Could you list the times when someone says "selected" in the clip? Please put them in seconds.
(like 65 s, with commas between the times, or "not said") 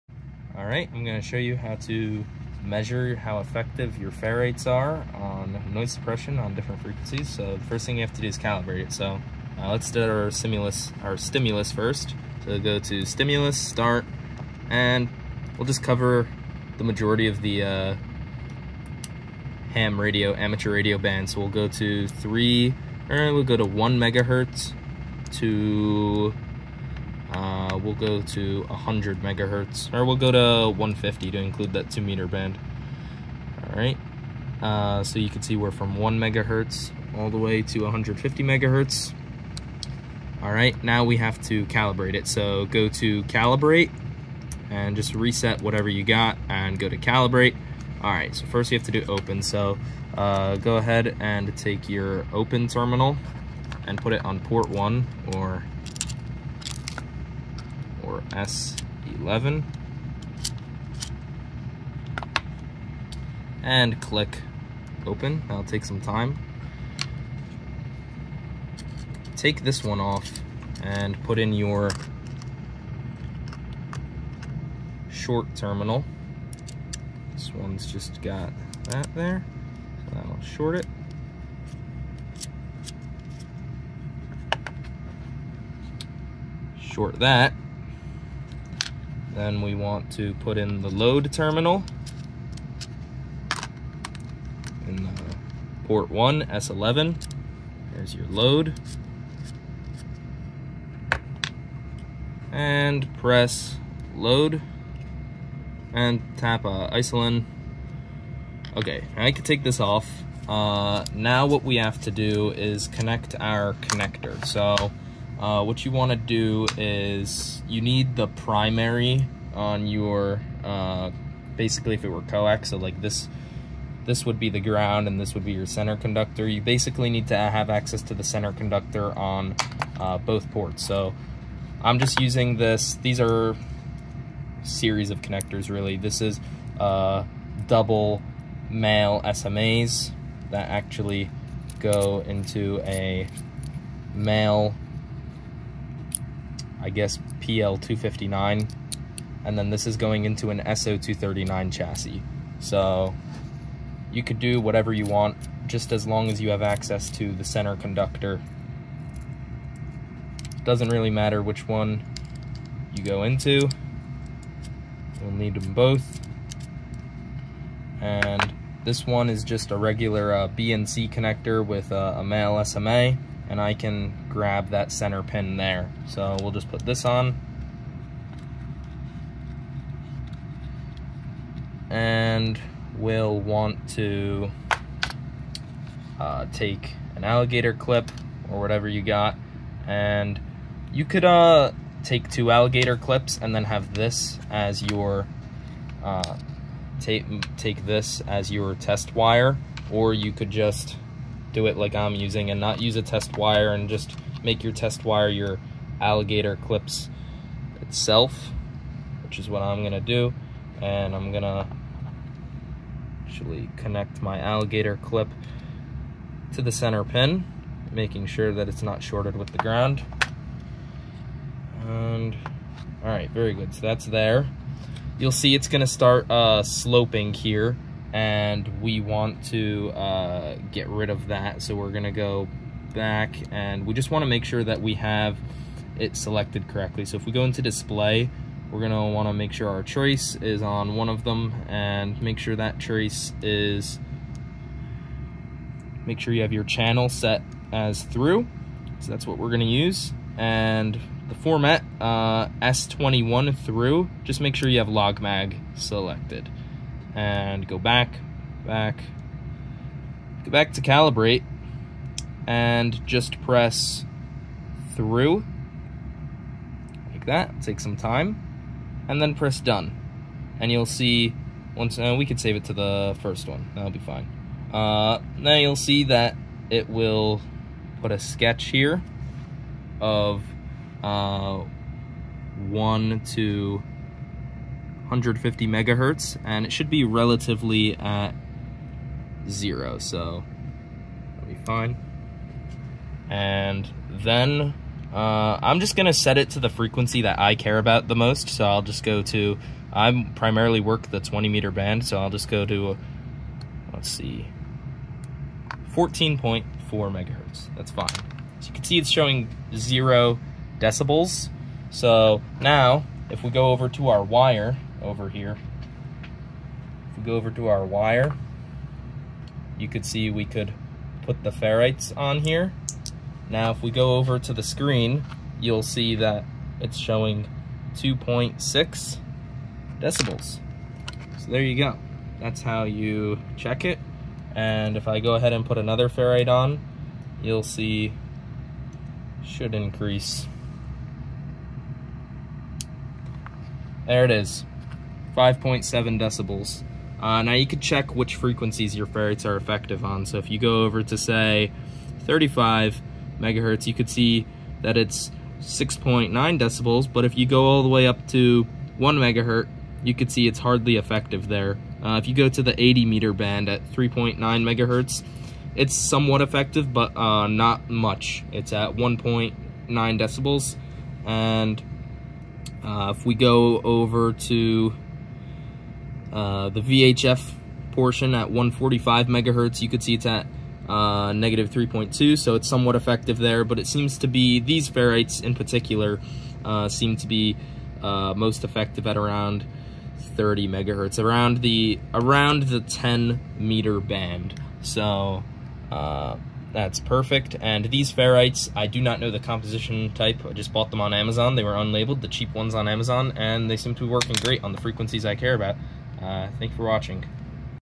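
236 s, 255 s.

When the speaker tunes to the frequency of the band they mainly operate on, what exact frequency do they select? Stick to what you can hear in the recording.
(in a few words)
14.4 MHz.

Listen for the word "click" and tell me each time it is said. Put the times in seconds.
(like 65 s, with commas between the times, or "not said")
64 s.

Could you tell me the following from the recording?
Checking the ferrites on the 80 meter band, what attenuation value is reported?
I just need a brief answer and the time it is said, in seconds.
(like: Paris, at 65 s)
1.9 decibels, at 368 s.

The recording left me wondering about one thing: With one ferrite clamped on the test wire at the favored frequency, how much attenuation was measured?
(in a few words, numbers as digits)
2.6 decibels.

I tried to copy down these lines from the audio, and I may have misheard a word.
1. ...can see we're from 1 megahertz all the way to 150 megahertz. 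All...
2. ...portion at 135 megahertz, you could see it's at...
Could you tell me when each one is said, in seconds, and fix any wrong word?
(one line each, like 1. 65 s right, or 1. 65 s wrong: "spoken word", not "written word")
1. 35 s right
2. 377 s wrong: "145", not "135".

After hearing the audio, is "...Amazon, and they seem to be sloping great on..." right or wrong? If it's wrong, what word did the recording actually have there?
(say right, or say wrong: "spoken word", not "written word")
wrong: "working", not "sloping".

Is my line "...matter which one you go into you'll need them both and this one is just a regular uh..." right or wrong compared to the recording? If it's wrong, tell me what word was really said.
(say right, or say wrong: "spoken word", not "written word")
right.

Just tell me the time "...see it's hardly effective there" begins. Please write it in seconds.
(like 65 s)
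360 s.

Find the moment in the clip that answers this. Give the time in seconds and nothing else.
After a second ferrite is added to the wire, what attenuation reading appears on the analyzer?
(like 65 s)
345 s.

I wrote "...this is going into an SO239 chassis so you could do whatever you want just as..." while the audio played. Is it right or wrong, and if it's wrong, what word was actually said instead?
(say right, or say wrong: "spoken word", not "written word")
right.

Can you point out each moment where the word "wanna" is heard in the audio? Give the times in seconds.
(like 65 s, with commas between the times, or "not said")
234 s, 239 s.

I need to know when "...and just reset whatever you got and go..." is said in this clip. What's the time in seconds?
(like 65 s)
44 s.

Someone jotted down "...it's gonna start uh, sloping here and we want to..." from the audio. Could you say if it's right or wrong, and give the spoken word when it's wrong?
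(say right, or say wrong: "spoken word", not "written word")
right.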